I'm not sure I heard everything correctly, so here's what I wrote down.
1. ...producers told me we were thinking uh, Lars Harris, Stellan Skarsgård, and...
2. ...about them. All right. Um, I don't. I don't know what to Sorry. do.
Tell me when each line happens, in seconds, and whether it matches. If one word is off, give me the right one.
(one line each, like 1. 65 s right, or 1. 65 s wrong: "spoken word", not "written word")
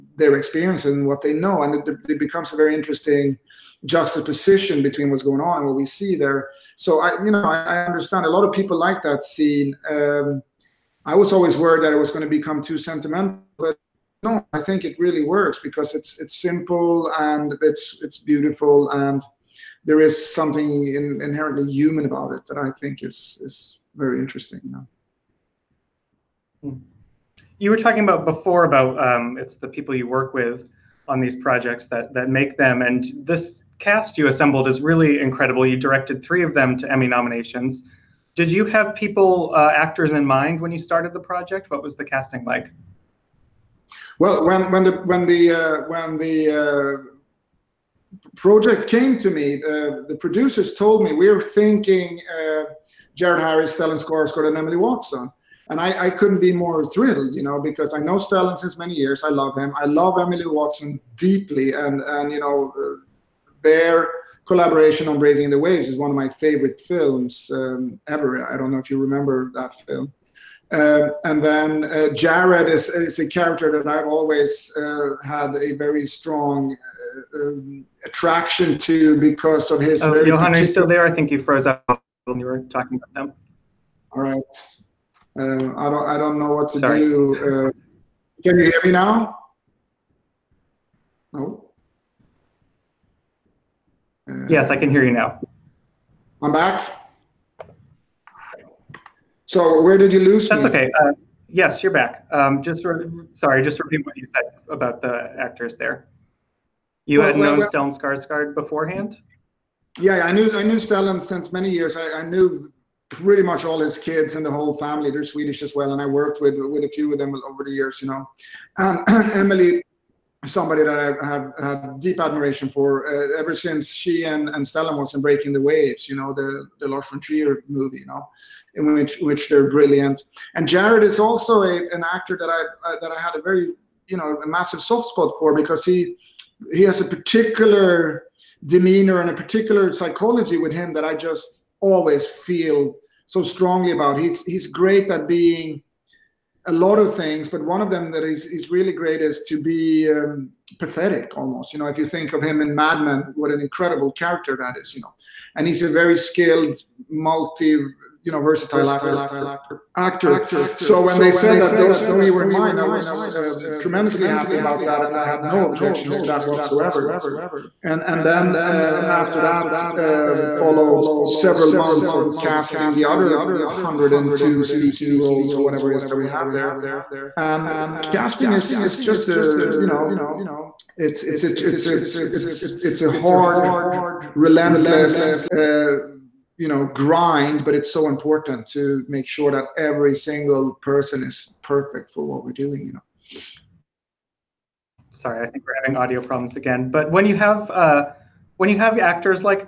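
1. 50 s wrong: "Jared", not "Lars"
2. 83 s right.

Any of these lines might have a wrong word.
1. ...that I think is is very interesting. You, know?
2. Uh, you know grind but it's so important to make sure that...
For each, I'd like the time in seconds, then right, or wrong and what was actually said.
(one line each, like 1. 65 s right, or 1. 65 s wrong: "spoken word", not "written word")
1. 22 s right
2. 185 s right.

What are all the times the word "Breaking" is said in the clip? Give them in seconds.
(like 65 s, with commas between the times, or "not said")
65 s, 125 s.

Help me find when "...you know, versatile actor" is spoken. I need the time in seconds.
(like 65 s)
157 s.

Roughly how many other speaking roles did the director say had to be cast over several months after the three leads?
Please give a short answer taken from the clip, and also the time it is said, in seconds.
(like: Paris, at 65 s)
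102, at 173 s.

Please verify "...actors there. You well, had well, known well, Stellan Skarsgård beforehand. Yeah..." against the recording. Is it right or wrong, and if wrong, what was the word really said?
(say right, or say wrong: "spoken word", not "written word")
right.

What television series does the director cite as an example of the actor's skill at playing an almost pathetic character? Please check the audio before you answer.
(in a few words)
Mad Men.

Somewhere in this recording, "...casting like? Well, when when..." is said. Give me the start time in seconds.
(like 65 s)
42 s.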